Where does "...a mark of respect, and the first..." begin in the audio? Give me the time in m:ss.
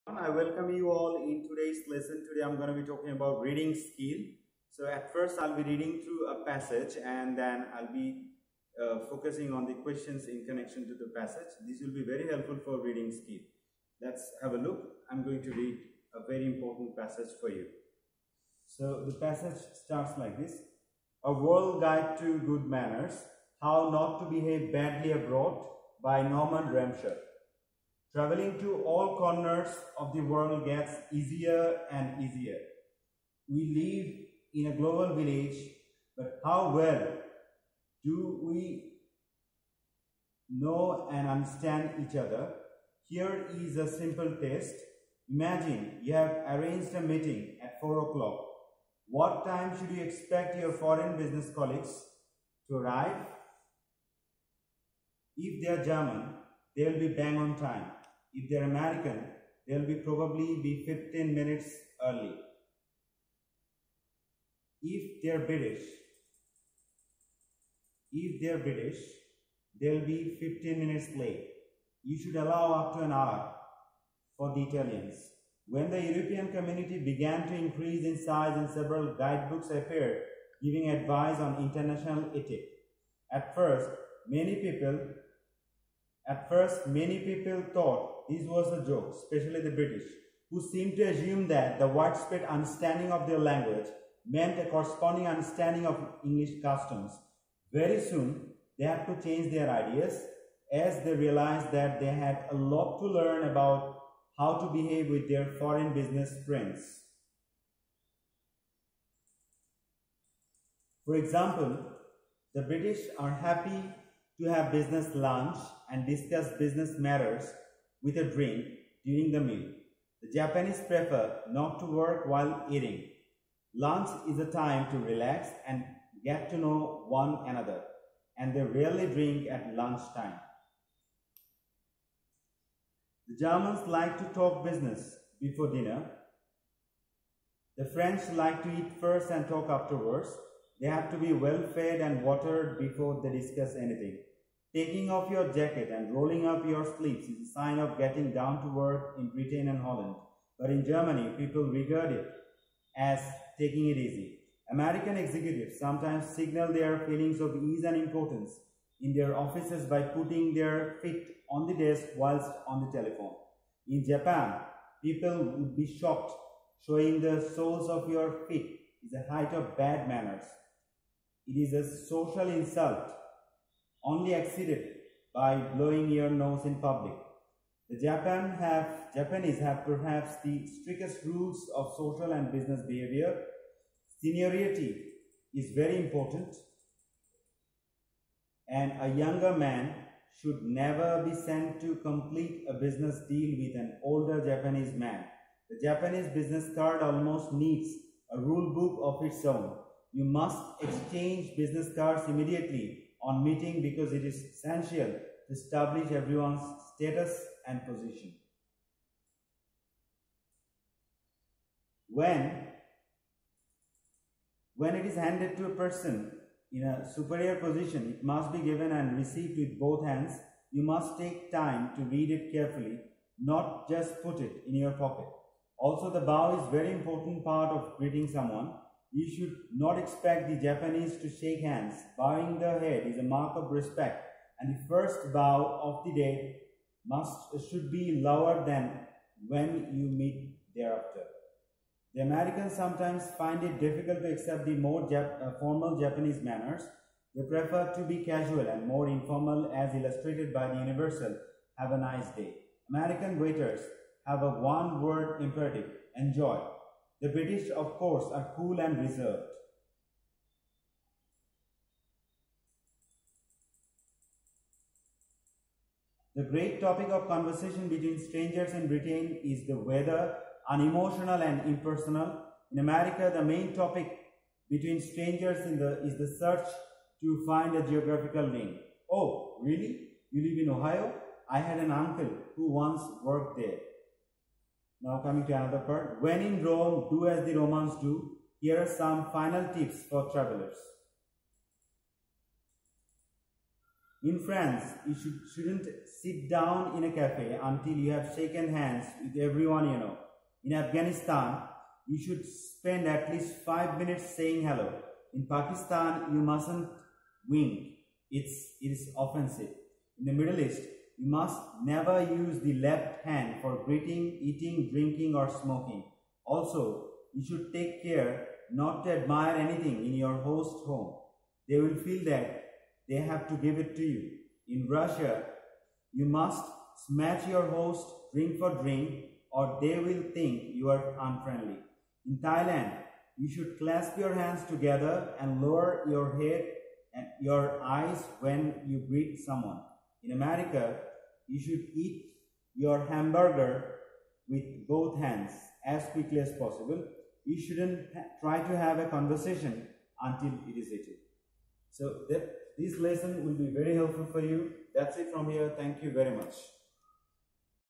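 3:53.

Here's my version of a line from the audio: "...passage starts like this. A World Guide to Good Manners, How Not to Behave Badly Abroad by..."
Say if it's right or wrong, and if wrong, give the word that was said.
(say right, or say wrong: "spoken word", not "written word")
right.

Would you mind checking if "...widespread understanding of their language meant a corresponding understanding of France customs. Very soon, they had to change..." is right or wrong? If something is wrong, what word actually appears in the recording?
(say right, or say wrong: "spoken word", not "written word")
wrong: "English", not "France".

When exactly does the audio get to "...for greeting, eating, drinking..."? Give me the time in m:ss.
5:13.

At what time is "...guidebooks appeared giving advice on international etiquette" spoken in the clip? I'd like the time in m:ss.
1:19.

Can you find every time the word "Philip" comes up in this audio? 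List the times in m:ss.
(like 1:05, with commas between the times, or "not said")
not said.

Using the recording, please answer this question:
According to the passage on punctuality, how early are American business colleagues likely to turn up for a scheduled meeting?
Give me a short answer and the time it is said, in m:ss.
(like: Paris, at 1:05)
15 minutes early, at 1:00.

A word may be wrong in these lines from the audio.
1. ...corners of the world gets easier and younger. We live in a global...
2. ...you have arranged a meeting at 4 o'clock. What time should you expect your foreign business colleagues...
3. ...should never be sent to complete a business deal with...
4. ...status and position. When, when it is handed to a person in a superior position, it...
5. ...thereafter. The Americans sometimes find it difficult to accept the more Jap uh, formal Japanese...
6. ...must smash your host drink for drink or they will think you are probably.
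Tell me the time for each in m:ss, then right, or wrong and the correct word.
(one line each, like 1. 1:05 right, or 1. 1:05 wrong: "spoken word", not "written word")
1. 0:29 wrong: "easier", not "younger"
2. 0:46 right
3. 3:10 right
4. 3:26 right
5. 4:00 right
6. 5:26 wrong: "unfriendly", not "probably".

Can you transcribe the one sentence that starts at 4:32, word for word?
In America, the main topic between strangers in the, is the search to find a geographical link.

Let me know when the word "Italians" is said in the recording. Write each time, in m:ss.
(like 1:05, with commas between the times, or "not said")
1:14.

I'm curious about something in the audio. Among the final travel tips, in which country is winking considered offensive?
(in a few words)
Pakistan.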